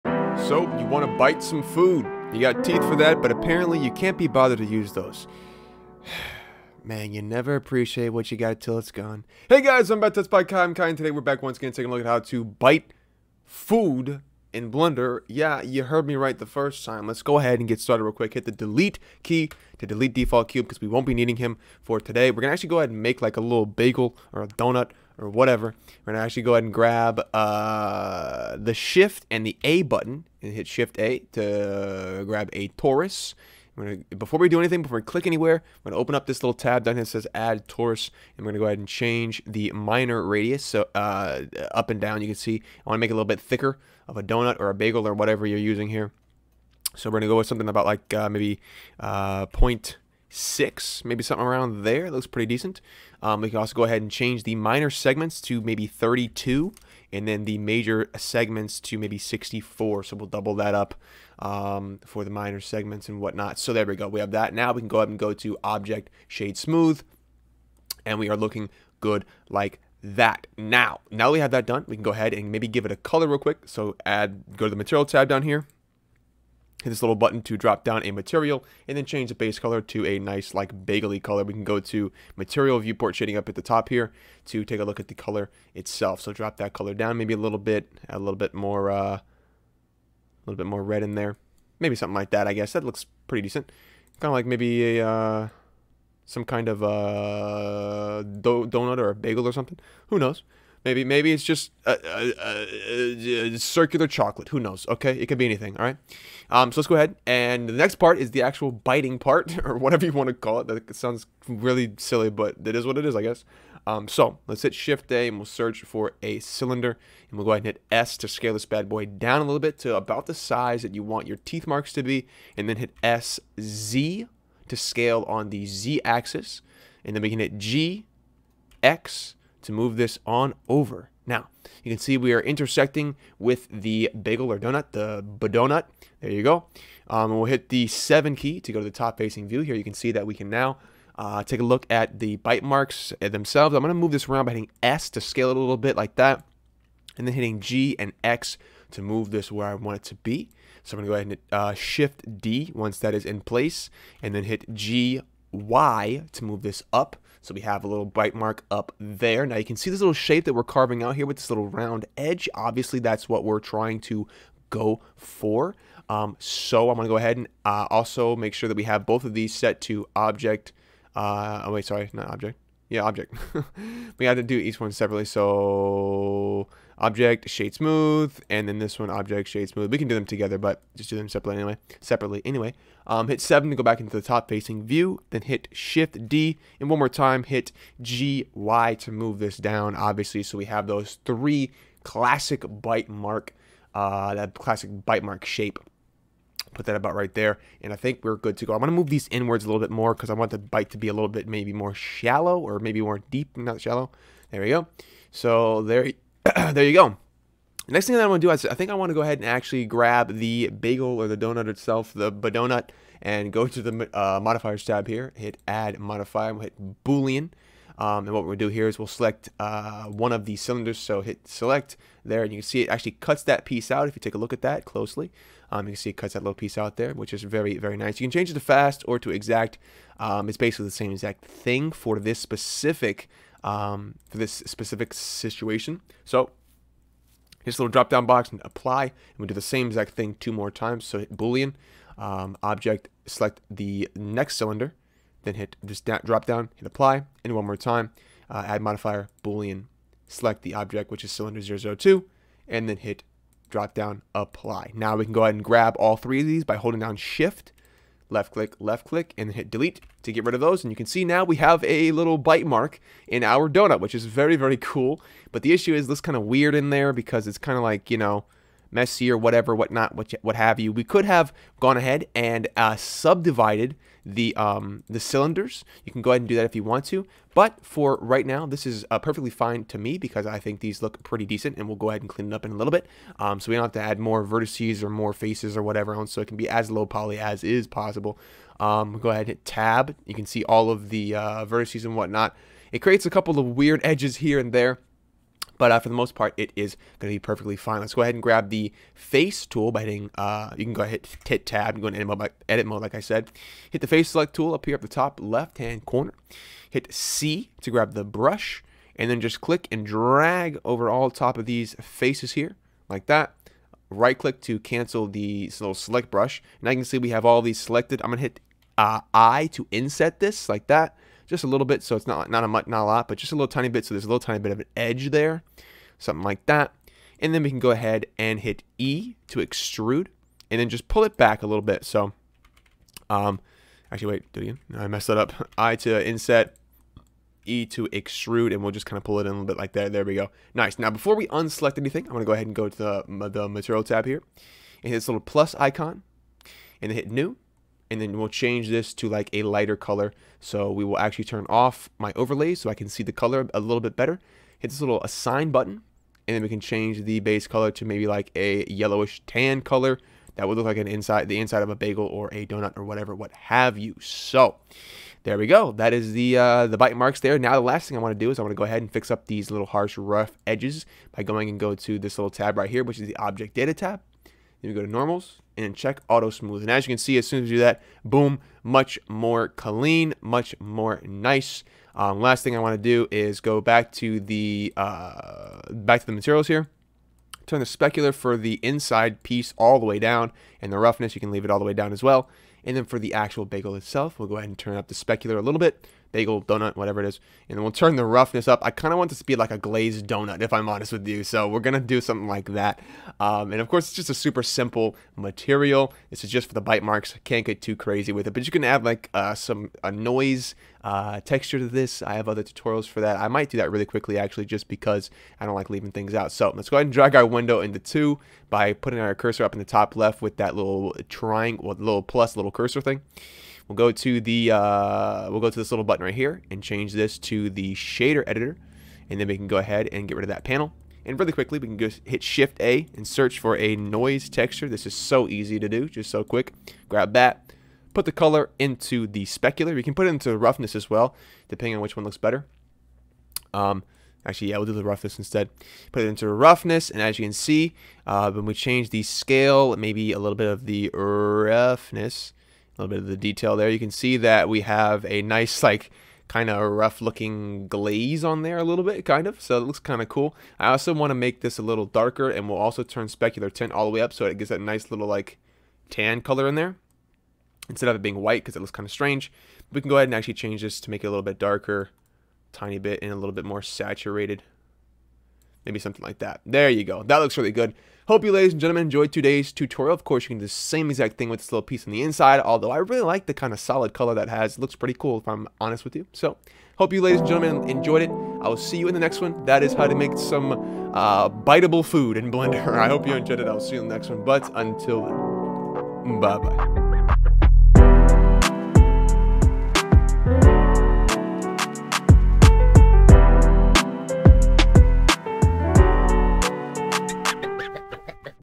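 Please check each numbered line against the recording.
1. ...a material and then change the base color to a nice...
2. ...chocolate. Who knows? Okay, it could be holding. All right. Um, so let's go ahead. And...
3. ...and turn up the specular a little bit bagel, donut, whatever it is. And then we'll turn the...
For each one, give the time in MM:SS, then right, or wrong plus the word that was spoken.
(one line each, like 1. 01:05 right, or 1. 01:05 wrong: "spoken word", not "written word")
1. 01:18 right
2. 01:44 wrong: "anything", not "holding"
3. 06:34 right.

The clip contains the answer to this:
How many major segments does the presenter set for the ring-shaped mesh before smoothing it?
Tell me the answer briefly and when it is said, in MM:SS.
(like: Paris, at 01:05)
64, at 00:59.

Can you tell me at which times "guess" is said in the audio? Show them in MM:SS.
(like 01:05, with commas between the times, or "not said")
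01:32, 01:53.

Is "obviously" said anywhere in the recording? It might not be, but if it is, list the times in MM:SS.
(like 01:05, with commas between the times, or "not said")
02:42, 03:09.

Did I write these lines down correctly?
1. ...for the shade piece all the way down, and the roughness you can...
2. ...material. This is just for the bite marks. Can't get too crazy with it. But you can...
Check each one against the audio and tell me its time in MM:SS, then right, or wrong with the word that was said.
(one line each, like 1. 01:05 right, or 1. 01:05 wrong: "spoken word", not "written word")
1. 06:28 wrong: "inside", not "shade"
2. 06:45 right.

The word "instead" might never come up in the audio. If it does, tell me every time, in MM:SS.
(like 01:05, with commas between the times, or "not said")
07:25, 07:47.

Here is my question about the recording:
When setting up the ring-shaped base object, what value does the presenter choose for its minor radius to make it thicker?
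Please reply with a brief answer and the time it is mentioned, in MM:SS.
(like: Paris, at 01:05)
0.6, at 00:49.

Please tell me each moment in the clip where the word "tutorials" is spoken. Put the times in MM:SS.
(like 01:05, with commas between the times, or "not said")
06:52, 07:59.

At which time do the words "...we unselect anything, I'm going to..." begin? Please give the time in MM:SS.
05:41.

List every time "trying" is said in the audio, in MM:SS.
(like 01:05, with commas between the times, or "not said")
02:43.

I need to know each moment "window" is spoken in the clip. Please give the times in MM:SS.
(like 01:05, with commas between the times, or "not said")
06:57.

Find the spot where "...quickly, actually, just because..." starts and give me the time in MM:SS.
06:54.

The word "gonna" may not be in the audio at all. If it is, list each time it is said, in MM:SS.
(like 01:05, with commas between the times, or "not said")
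00:26, 00:33, 03:18.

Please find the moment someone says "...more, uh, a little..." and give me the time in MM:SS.
01:28.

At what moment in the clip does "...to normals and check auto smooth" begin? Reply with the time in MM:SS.
06:15.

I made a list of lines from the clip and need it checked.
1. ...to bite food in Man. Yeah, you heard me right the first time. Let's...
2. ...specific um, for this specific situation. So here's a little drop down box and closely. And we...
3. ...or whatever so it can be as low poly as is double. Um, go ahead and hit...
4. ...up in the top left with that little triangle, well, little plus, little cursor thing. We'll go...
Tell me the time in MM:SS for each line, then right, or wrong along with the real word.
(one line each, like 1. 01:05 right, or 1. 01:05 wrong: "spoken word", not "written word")
1. 00:12 wrong: "Blender", not "Man"
2. 03:52 wrong: "apply", not "closely"
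3. 04:45 wrong: "possible", not "double"
4. 06:59 right.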